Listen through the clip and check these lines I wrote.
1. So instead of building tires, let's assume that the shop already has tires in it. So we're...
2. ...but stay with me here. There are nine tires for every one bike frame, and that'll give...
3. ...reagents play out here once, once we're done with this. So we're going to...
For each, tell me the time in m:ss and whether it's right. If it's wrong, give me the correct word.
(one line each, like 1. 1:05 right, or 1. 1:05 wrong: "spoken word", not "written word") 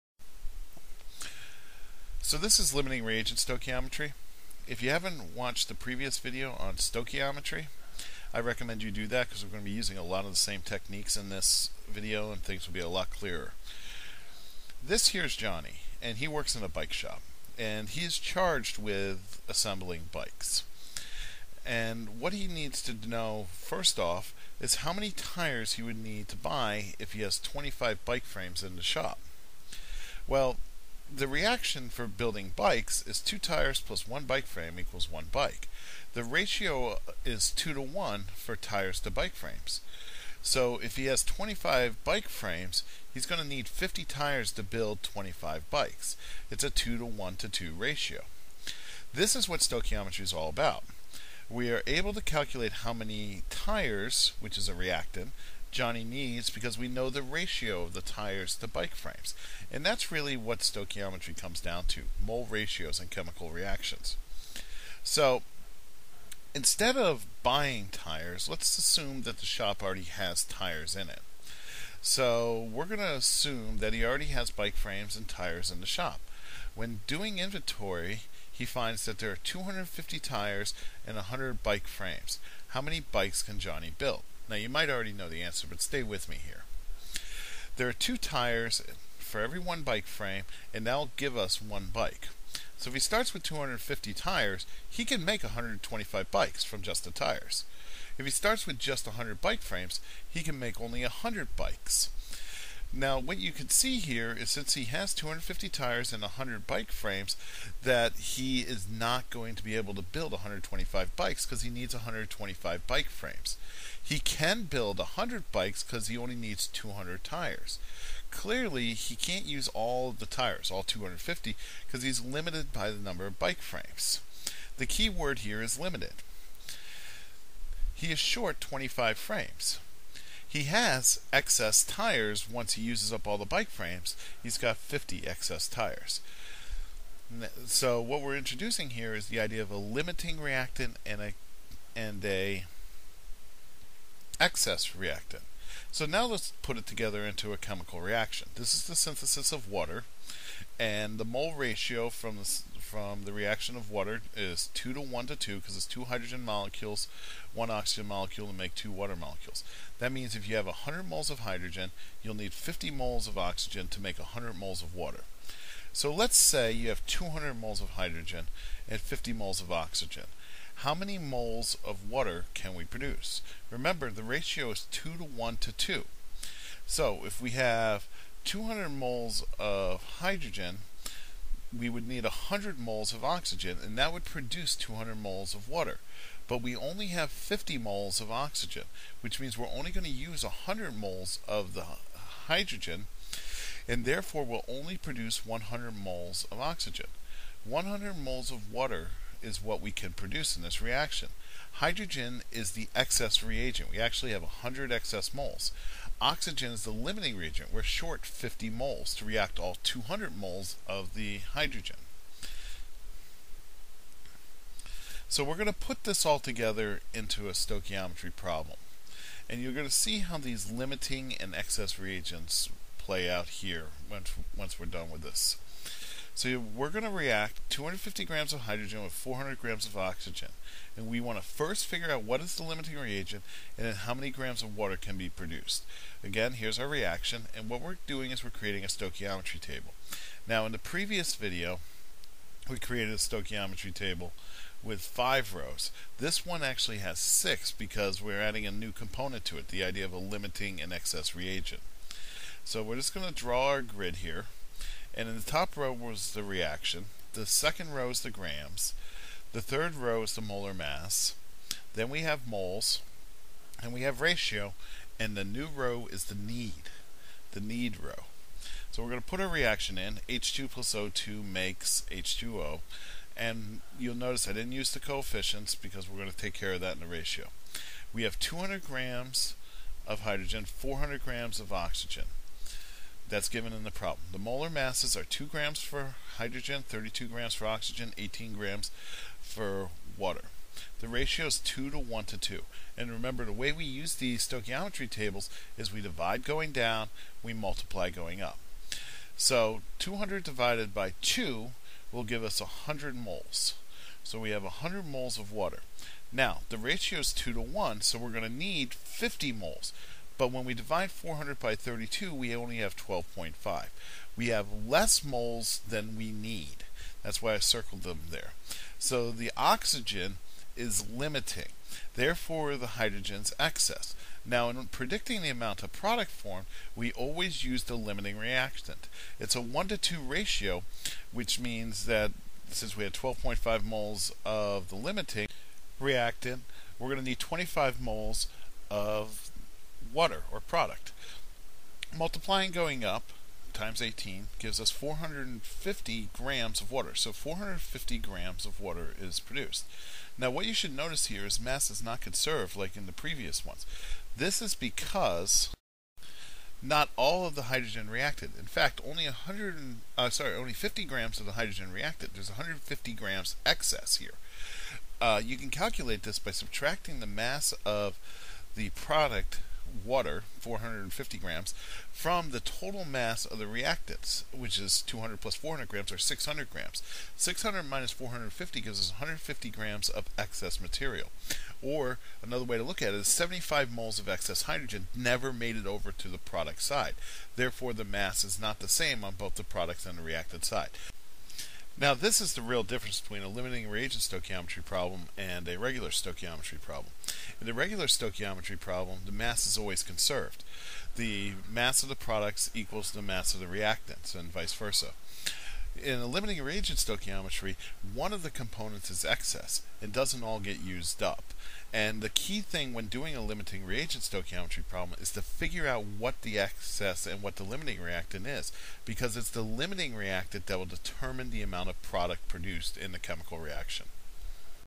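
1. 1:05 wrong: "buying", not "building"
2. 1:25 wrong: "two", not "nine"
3. 3:41 right.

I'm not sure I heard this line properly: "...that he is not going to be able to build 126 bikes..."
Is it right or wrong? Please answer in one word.
wrong.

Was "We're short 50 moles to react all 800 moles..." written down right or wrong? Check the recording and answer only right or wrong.
wrong.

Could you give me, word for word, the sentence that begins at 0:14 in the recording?
This here's Johnny and he works in a bike shop and he's charged with assembling bikes.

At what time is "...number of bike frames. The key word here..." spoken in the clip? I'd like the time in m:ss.
2:02.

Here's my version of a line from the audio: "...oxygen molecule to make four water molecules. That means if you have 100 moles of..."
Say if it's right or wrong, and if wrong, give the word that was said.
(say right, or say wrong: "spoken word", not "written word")
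wrong: "two", not "four".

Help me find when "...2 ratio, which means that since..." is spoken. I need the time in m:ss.
5:29.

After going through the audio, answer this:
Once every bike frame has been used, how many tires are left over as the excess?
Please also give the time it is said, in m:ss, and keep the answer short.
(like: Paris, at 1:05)
50 excess tires, at 2:14.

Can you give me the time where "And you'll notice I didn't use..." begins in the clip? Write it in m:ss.
4:33.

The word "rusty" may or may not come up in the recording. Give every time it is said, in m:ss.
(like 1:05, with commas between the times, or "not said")
not said.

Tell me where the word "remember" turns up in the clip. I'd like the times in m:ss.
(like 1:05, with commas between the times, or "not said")
2:53, 4:53.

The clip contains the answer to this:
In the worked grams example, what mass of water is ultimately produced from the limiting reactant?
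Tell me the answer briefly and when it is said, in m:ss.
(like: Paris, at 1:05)
450 grams, at 5:47.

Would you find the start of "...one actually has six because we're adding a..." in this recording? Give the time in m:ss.
4:06.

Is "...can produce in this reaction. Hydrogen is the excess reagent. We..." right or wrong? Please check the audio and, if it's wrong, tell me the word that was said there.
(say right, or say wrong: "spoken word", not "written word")
right.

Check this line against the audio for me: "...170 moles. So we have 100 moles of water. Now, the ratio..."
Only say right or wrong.
wrong.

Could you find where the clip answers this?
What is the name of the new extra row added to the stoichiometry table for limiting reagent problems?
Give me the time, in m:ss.
4:27.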